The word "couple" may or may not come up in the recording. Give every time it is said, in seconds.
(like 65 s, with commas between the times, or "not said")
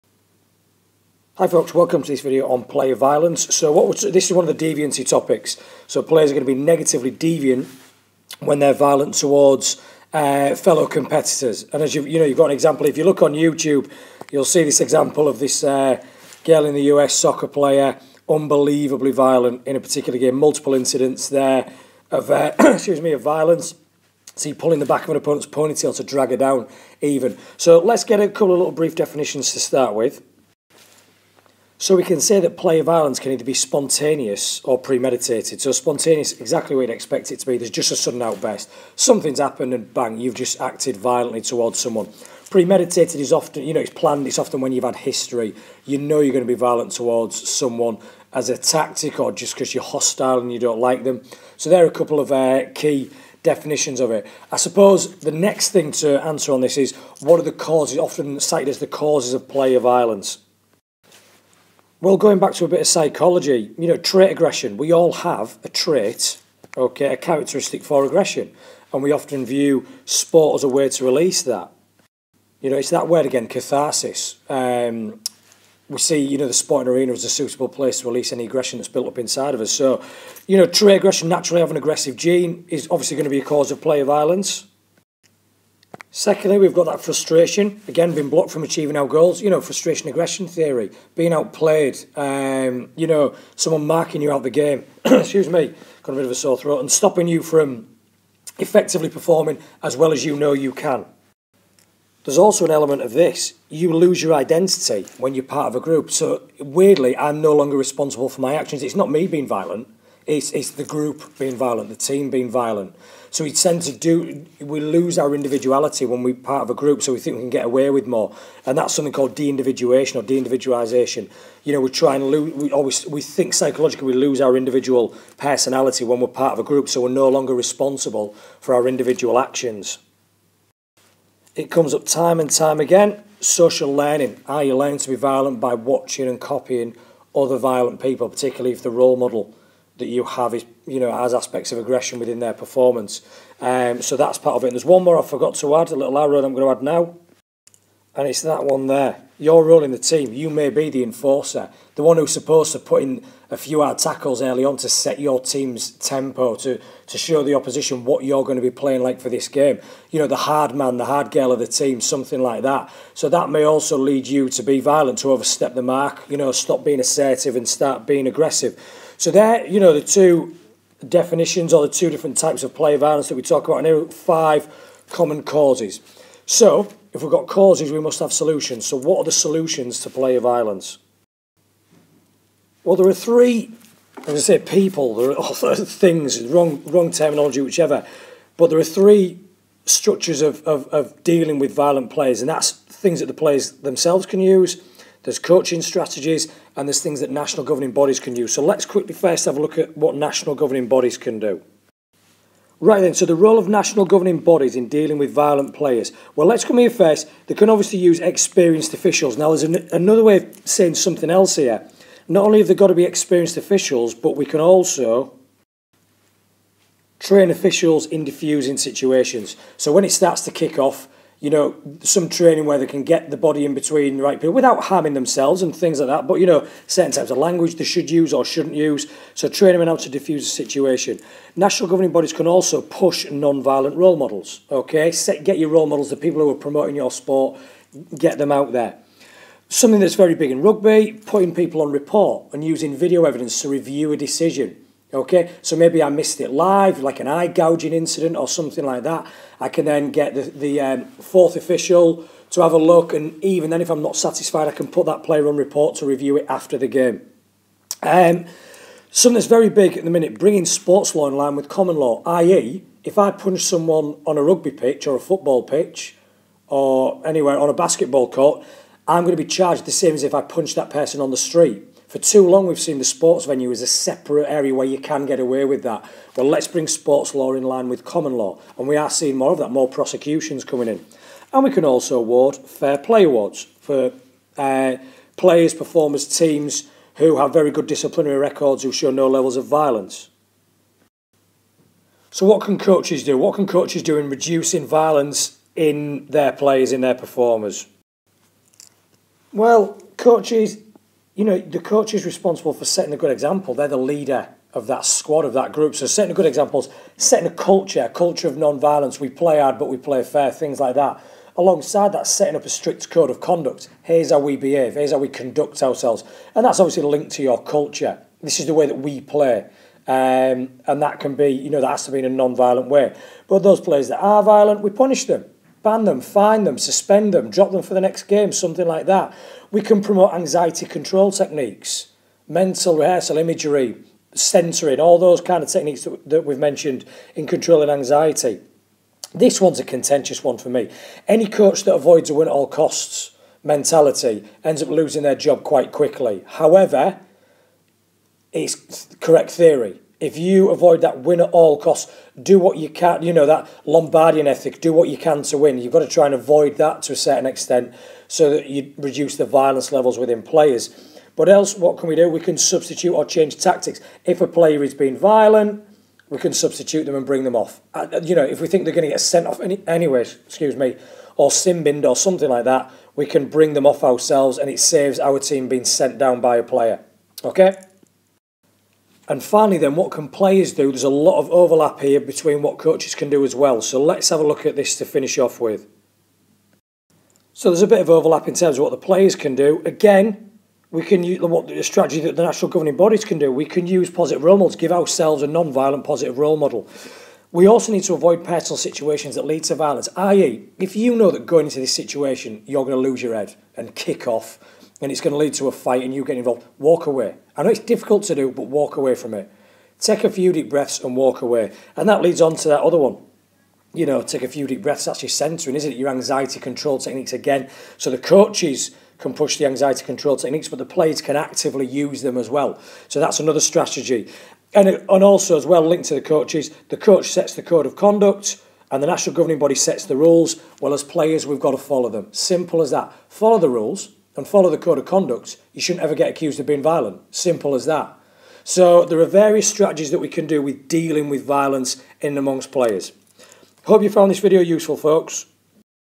28 s, 51 s.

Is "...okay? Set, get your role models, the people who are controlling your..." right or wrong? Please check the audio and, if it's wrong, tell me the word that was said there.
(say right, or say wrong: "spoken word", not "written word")
wrong: "promoting", not "controlling".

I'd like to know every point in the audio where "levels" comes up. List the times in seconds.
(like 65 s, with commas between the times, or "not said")
289 s, 359 s.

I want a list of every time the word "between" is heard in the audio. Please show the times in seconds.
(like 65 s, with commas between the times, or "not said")
223 s, 382 s.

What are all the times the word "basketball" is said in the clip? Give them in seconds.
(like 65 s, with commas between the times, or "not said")
267 s.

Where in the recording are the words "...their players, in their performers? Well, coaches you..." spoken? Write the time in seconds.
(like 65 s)
296 s.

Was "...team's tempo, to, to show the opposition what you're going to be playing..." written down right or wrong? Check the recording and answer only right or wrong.
right.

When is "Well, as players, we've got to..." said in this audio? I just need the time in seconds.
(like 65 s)
430 s.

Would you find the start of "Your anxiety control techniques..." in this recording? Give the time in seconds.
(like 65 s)
415 s.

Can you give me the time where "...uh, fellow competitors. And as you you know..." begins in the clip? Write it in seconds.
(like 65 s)
10 s.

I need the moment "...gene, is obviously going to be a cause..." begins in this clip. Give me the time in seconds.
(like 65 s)
82 s.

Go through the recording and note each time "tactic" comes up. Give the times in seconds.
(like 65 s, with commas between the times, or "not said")
48 s, 363 s.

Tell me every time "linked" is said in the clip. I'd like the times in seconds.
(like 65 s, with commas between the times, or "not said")
317 s, 425 s.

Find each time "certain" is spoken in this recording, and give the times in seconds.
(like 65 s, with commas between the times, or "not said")
226 s, 357 s.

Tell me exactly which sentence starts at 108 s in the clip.
It's not me being violent, it's, it's the group being violent, the team being violent.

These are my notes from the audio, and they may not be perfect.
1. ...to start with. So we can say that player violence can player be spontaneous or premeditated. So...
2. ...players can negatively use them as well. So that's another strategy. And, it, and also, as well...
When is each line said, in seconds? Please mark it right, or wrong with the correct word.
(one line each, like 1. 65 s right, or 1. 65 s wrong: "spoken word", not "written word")
1. 29 s wrong: "either", not "player"
2. 420 s wrong: "actively", not "negatively".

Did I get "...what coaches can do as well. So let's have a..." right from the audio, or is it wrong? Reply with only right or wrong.
right.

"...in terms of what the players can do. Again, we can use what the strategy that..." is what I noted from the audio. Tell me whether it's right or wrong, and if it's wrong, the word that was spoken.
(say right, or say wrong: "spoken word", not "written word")
right.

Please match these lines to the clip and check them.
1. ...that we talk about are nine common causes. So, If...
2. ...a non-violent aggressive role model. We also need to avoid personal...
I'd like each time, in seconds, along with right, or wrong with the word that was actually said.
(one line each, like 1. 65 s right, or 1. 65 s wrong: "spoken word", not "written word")
1. 173 s wrong: "five", not "nine"
2. 395 s wrong: "positive", not "aggressive".